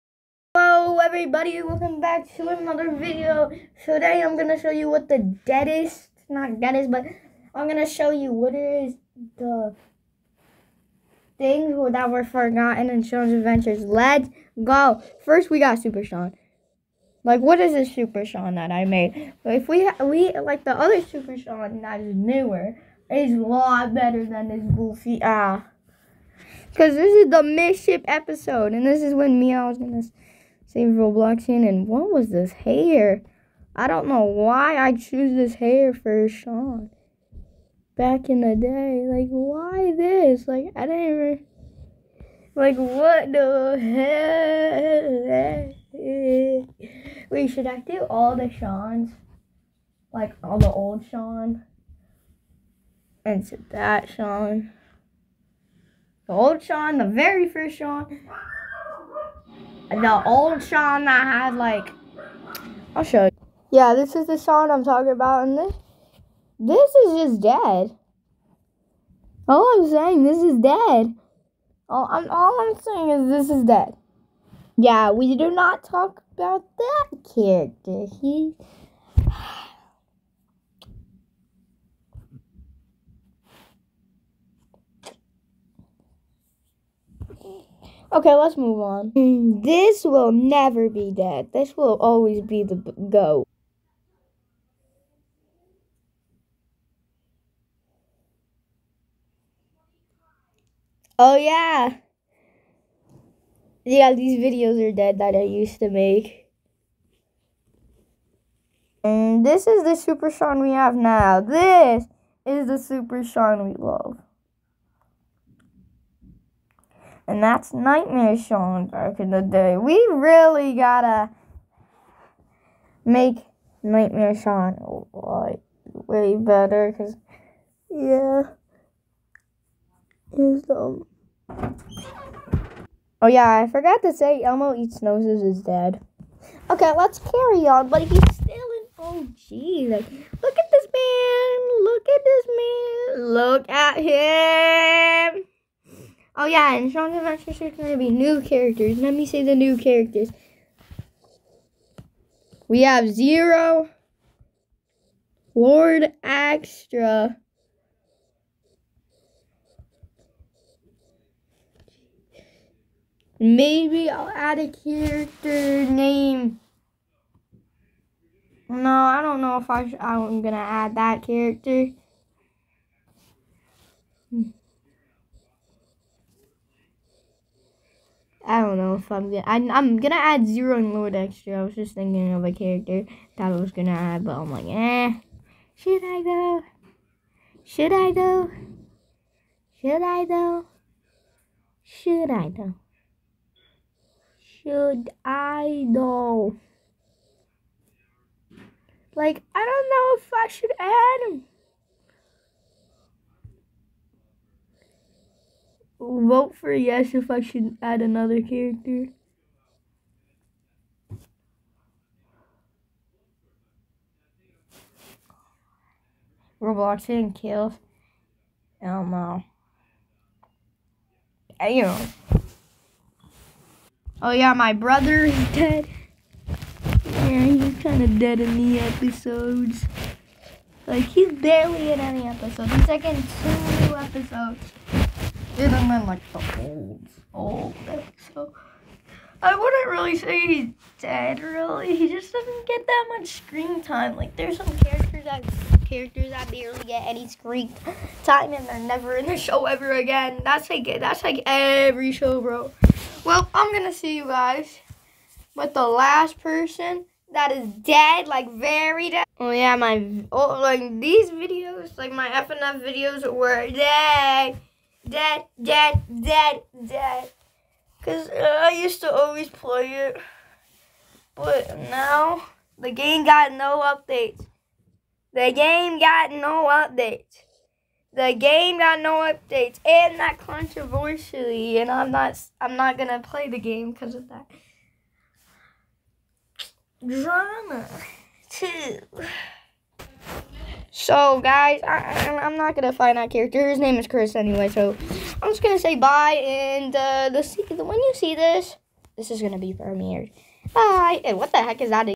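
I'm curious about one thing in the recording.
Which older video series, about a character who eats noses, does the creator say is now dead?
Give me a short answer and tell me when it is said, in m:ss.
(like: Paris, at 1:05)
Elmo eats noses, at 2:14.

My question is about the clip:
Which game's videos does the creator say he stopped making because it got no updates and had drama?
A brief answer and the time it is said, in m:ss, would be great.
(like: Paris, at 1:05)
FNF, at 4:22.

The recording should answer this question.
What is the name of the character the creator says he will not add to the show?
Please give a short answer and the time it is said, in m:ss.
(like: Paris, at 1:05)
Chris, at 4:54.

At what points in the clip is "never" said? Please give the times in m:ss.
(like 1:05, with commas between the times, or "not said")
1:30, 4:08.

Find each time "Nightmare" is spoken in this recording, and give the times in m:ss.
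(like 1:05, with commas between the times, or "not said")
1:57, 2:03.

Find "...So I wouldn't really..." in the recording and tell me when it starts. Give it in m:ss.
3:58.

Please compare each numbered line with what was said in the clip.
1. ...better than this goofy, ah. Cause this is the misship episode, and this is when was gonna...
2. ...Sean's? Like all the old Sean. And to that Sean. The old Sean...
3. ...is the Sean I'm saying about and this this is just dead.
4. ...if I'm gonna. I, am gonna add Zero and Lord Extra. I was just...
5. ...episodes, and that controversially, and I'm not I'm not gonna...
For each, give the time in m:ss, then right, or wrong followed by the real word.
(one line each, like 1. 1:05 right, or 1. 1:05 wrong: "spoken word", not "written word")
1. 0:23 right
2. 0:48 right
3. 1:04 wrong: "talking", not "saying"
4. 2:58 right
5. 4:39 wrong: "updates", not "episodes".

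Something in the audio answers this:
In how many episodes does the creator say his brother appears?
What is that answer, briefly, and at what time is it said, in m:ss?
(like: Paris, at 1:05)
2, at 3:53.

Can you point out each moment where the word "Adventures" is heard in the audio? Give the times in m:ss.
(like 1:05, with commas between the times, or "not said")
0:13, 2:27.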